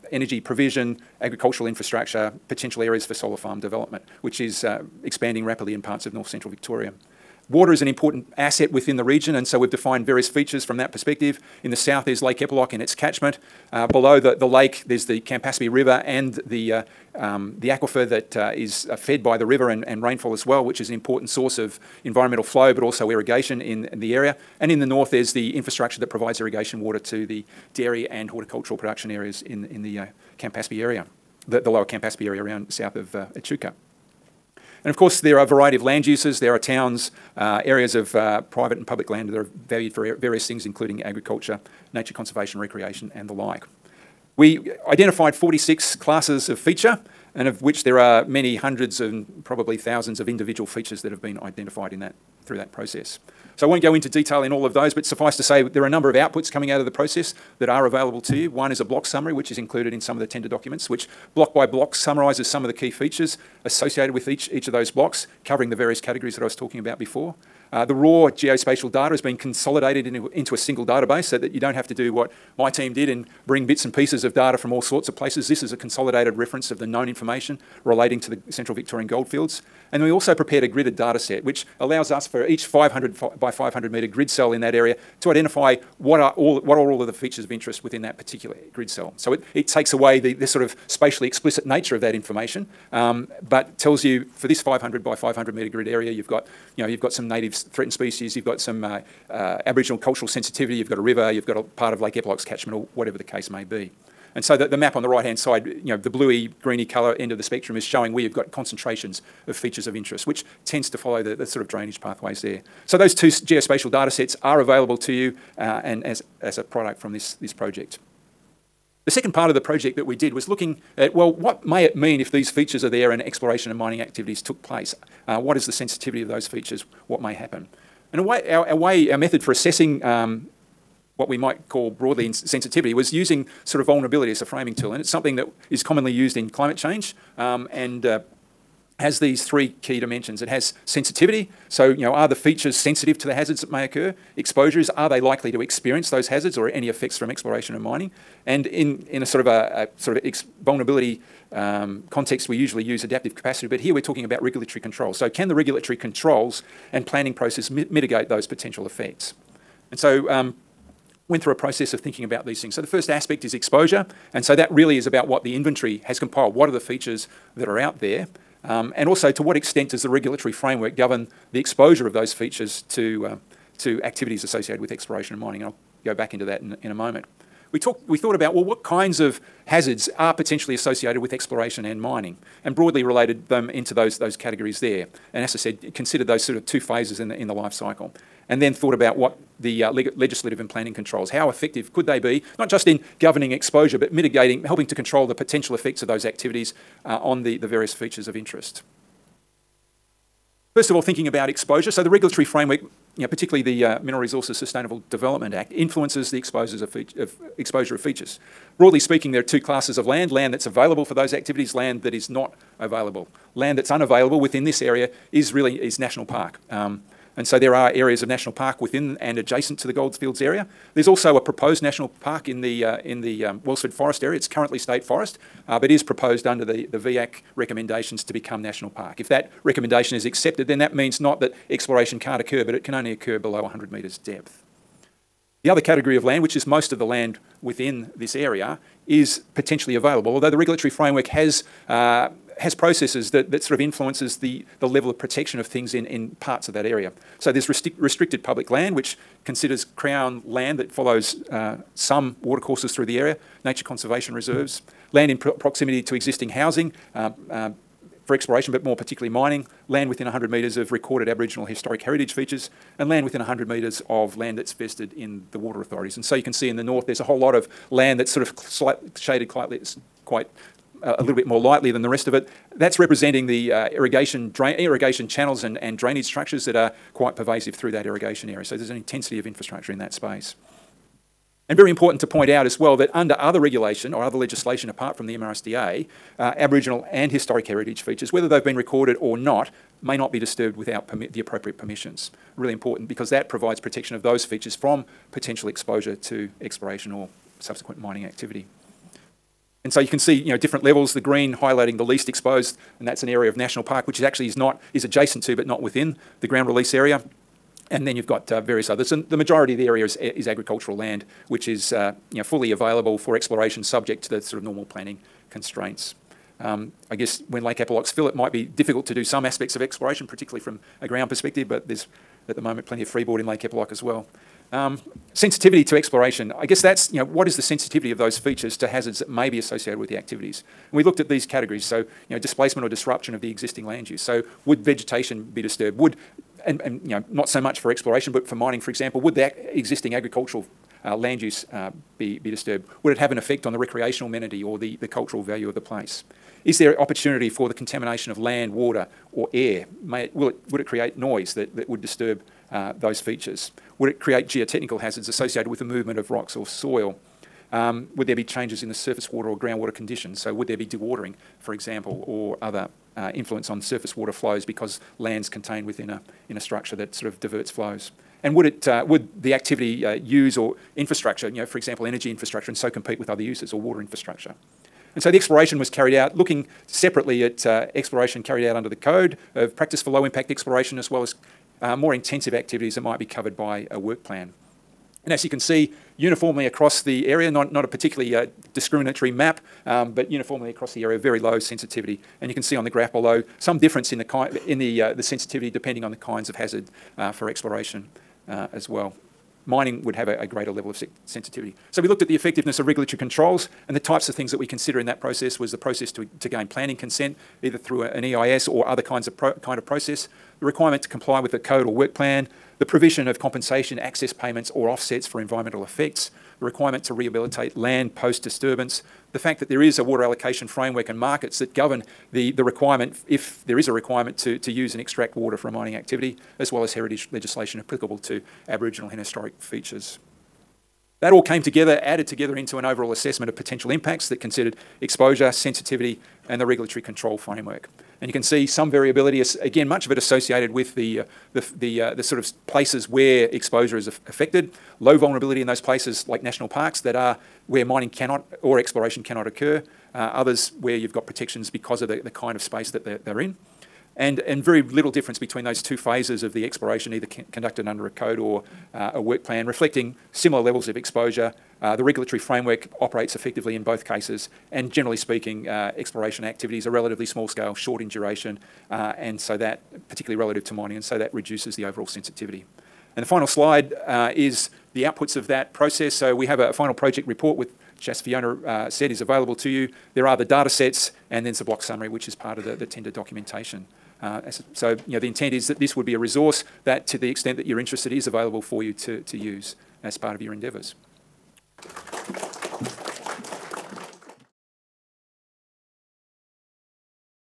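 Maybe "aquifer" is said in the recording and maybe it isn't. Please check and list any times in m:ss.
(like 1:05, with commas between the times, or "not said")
0:17.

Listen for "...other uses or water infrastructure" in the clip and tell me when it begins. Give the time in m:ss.
6:13.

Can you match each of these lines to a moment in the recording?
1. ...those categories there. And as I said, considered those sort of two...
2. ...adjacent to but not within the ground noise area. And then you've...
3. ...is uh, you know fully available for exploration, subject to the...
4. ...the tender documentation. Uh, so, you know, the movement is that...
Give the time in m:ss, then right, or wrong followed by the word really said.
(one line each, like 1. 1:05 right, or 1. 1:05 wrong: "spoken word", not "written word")
1. 3:04 right
2. 5:05 wrong: "release", not "noise"
3. 5:11 right
4. 8:02 wrong: "intent", not "movement".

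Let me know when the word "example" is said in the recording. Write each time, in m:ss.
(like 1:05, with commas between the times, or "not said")
5:38, 6:01, 6:11.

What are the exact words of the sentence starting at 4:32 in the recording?
That's representing the uh, irrigation, drain, irrigation channels and, and drainage structures that are quite pervasive through that irrigation area.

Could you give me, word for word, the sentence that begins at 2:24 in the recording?
Exposures, are they likely to experience those hazards or any effects from exploration and mining?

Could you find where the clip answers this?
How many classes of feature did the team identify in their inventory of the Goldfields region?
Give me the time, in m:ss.
0:45.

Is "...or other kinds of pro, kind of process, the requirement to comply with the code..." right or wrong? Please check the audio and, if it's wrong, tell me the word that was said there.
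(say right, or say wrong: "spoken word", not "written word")
right.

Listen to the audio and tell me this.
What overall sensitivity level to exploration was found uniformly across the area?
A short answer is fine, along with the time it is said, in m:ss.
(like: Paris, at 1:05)
Very low, at 6:31.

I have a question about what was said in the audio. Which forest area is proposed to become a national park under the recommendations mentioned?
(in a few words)
Wellsford Forest.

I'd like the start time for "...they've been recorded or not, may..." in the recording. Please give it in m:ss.
4:48.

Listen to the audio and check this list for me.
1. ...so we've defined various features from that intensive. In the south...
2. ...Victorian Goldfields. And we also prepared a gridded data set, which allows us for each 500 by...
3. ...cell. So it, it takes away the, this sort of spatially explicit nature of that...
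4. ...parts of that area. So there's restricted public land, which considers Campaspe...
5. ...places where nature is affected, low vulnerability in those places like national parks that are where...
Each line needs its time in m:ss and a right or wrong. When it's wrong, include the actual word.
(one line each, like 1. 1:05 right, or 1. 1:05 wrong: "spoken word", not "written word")
1. 0:09 wrong: "perspective", not "intensive"
2. 1:18 right
3. 1:28 right
4. 4:06 wrong: "Crown", not "Campaspe"
5. 7:22 wrong: "exposure", not "nature".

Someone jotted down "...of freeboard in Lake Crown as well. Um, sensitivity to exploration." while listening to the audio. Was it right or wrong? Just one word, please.
wrong.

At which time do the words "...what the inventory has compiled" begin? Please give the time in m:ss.
2:45.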